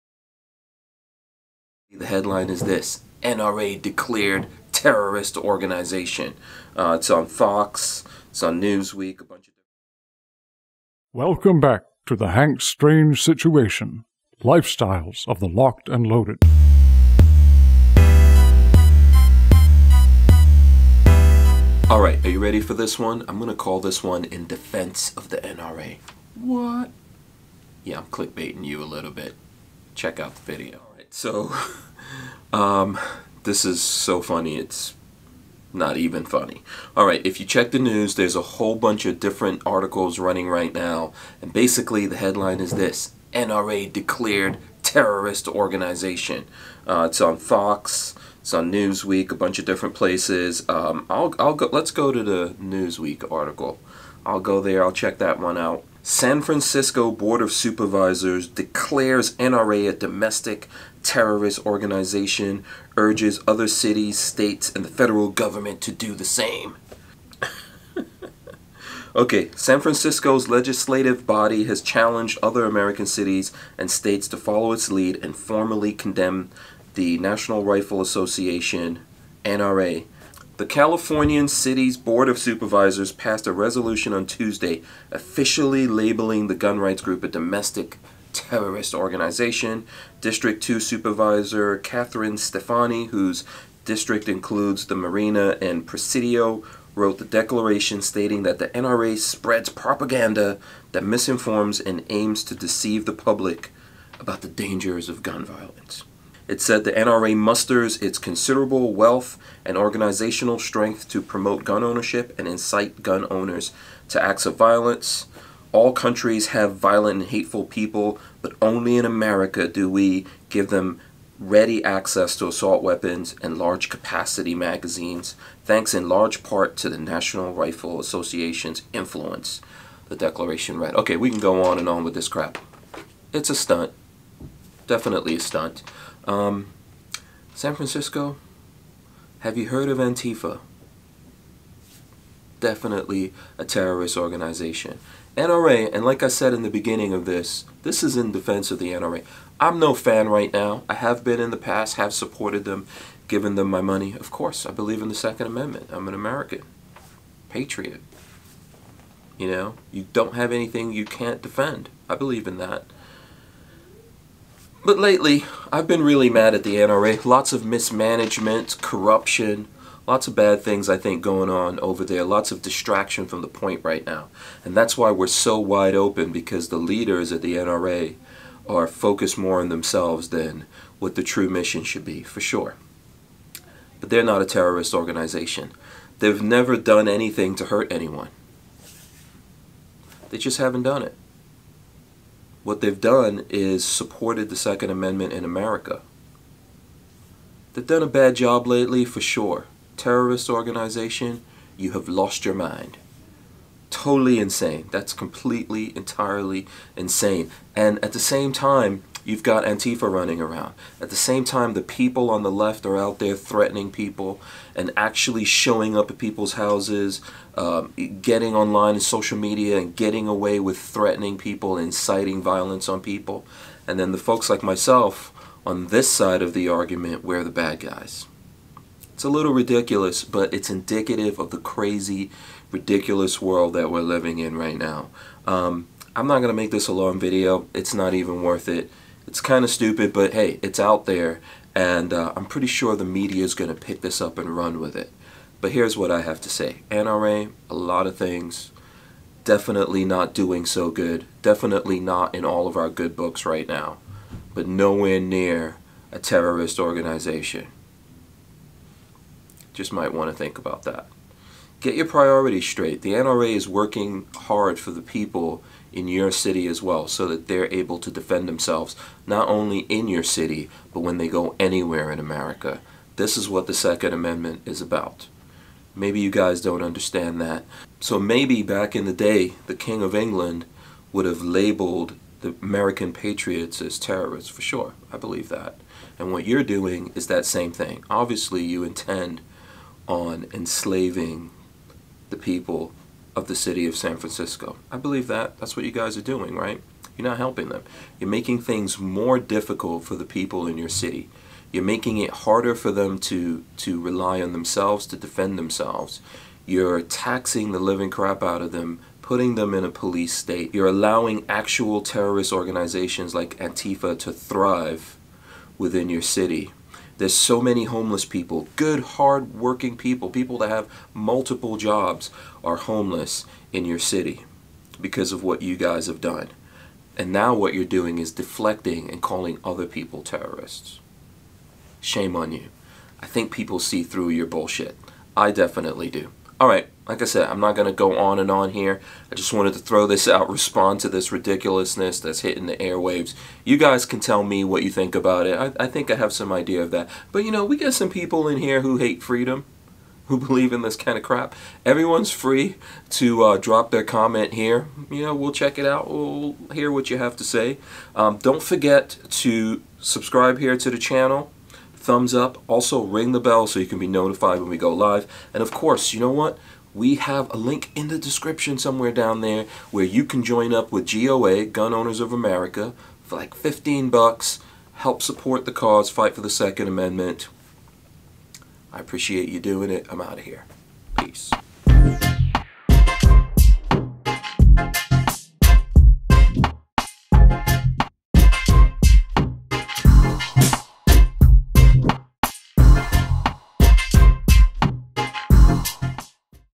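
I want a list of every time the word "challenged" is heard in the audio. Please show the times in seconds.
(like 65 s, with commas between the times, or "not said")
71 s.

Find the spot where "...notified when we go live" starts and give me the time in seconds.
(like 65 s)
364 s.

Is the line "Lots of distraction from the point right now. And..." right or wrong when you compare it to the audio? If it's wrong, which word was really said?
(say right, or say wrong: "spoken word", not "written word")
right.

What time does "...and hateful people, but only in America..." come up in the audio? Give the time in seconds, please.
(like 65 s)
117 s.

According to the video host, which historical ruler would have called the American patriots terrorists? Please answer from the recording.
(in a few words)
King of England.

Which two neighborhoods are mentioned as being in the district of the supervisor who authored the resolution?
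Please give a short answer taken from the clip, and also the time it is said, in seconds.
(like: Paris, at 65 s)
Marina and Presidio, at 94 s.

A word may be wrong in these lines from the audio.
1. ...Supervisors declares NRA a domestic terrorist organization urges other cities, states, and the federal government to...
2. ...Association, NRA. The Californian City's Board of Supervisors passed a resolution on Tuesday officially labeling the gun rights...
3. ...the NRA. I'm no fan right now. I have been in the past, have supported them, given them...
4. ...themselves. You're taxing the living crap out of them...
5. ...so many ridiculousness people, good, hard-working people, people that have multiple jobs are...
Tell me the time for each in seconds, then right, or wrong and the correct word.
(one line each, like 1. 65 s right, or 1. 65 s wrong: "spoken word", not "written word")
1. 57 s right
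2. 78 s right
3. 148 s right
4. 305 s right
5. 317 s wrong: "homeless", not "ridiculousness".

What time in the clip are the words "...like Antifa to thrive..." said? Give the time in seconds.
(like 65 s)
313 s.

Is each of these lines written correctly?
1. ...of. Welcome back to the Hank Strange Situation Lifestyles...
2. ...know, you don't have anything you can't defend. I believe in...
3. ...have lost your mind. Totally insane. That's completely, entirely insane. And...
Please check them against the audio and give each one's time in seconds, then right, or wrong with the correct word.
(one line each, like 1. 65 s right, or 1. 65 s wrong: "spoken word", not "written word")
1. 9 s right
2. 159 s right
3. 201 s right.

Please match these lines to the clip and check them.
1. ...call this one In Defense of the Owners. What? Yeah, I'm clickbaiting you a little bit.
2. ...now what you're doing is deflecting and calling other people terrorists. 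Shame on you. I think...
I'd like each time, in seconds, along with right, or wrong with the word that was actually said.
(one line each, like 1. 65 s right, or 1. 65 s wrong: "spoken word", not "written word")
1. 23 s wrong: "NRA", not "Owners"
2. 327 s right.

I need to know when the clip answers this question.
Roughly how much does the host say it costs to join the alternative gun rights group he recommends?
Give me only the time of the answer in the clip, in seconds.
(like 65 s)
373 s.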